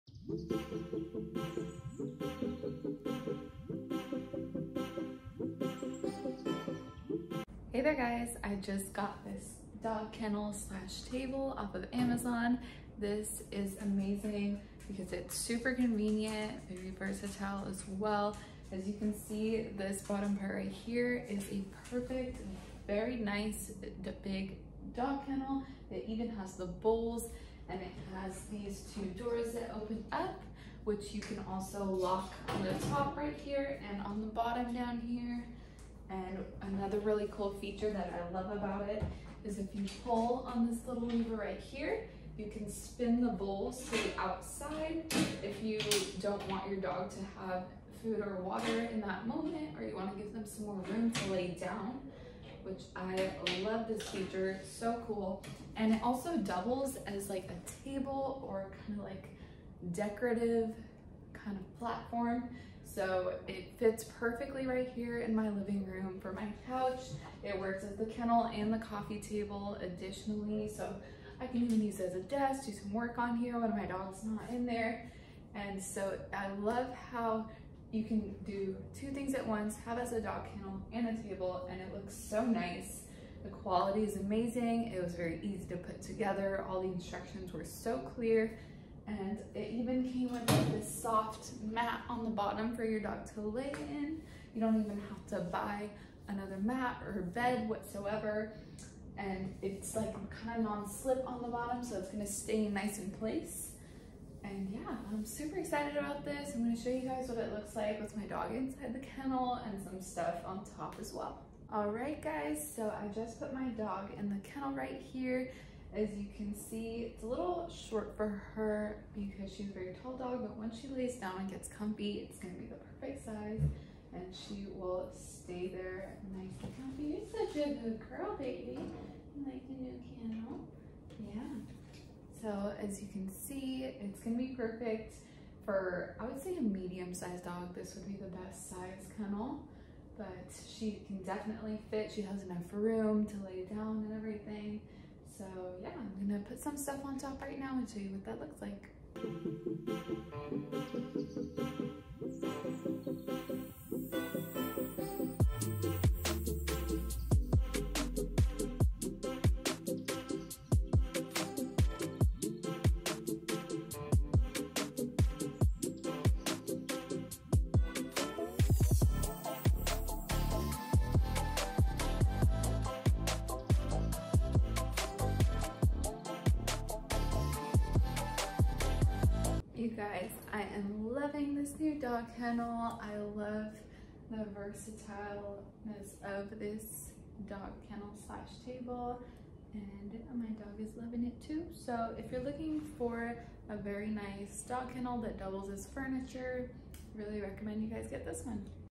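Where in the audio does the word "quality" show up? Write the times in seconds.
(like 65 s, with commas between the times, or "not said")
83 s.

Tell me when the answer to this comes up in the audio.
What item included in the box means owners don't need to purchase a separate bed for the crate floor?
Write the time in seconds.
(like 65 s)
90 s.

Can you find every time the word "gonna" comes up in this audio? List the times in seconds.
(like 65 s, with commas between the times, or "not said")
102 s, 106 s, 122 s, 134 s, 146 s.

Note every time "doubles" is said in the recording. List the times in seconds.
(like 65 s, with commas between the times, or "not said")
56 s, 195 s.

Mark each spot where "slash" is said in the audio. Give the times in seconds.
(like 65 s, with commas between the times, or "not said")
10 s, 188 s.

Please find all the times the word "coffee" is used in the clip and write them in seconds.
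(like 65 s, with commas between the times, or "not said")
68 s.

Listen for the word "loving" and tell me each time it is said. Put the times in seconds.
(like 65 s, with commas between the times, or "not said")
181 s, 190 s.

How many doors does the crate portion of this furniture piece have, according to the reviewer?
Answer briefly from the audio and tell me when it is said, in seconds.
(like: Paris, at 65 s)
2, at 28 s.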